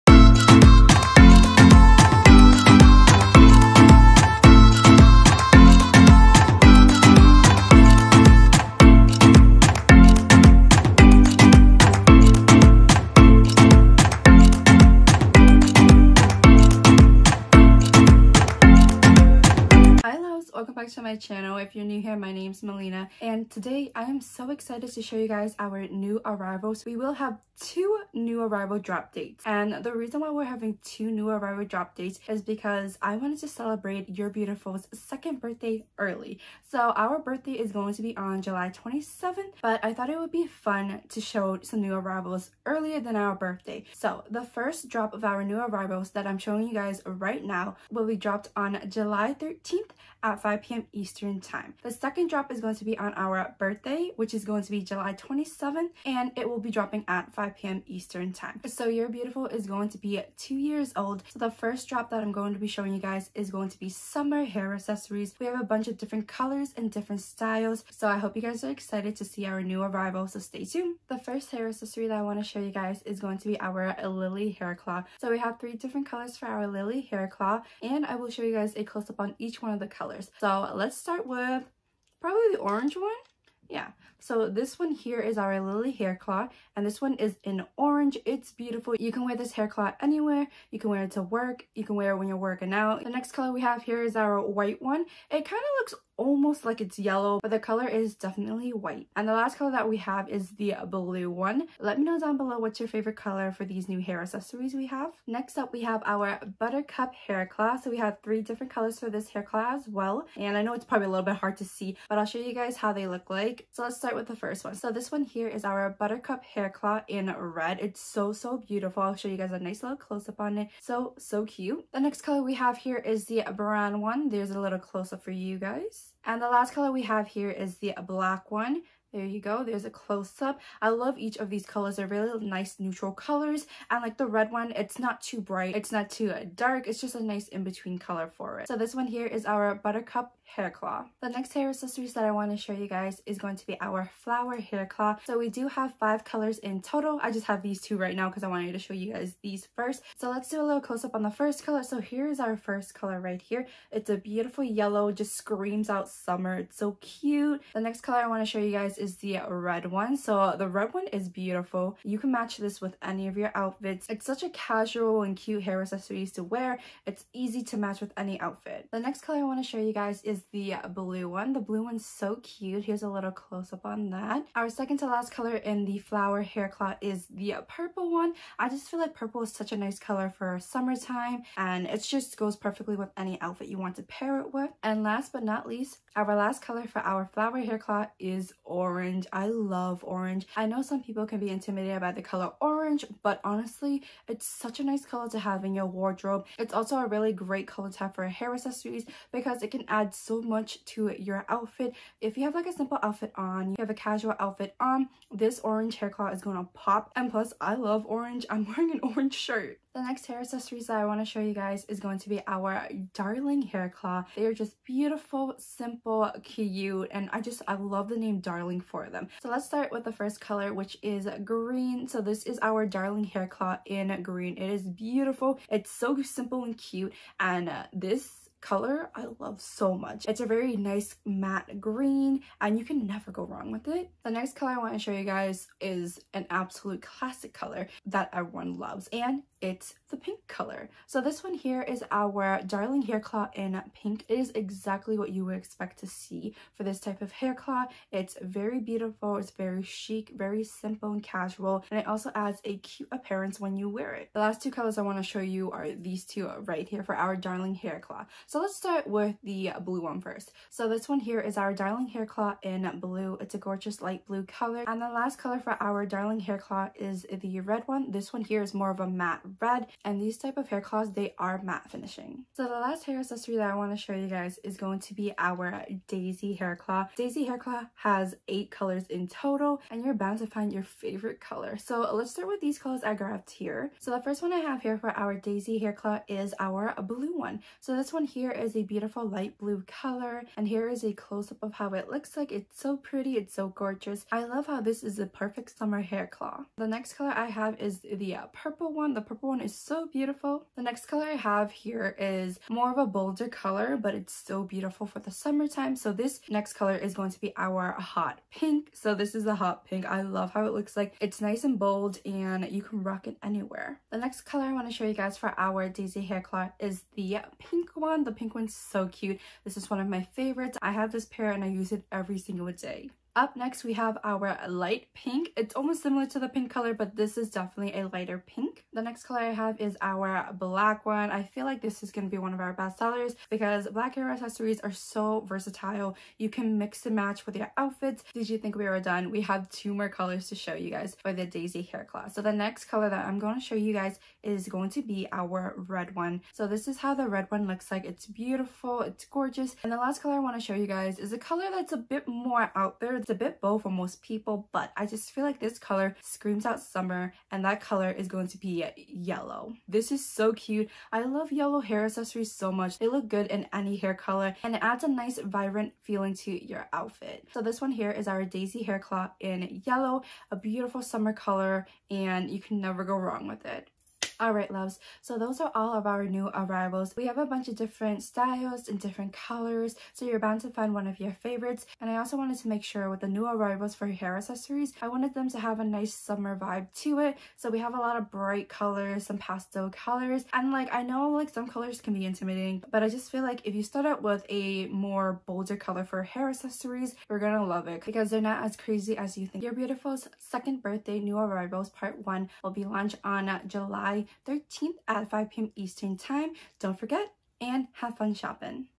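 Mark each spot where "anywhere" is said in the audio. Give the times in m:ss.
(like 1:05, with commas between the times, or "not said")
1:30, 5:13.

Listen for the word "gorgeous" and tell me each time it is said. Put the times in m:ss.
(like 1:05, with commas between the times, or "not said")
4:23, 4:53, 5:49.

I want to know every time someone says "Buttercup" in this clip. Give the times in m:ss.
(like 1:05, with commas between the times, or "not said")
1:46, 1:55, 2:19.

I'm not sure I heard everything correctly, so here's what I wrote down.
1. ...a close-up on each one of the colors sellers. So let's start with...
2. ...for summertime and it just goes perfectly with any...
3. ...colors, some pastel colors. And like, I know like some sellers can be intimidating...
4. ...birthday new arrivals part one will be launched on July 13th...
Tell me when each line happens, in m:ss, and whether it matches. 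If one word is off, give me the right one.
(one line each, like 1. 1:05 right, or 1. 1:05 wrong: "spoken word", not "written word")
1. 1:18 wrong: "colors", not "sellers"
2. 3:00 right
3. 6:28 wrong: "colors", not "sellers"
4. 6:40 right.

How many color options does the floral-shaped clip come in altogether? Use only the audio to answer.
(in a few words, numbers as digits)
5.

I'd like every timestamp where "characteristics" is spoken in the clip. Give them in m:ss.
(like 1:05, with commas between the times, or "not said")
not said.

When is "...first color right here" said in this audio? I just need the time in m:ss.
2:32.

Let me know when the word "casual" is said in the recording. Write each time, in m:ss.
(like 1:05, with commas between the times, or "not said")
2:44, 3:24, 4:11.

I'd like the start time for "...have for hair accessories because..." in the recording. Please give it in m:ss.
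3:17.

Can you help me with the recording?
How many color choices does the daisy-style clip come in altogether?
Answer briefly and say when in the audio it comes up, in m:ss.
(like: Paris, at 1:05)
8, at 4:38.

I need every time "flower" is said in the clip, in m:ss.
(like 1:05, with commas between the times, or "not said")
2:24, 2:55, 3:07.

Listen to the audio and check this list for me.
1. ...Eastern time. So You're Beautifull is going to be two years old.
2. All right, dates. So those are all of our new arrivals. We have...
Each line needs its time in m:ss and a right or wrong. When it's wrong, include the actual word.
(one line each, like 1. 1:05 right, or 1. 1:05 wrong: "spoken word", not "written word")
1. 0:57 right
2. 6:14 wrong: "loves", not "dates".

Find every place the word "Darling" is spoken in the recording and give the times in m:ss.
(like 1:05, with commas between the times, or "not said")
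3:33, 3:38, 3:42, 4:02, 4:17, 4:21, 4:26.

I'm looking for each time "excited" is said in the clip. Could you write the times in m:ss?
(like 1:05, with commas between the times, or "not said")
0:24, 1:08.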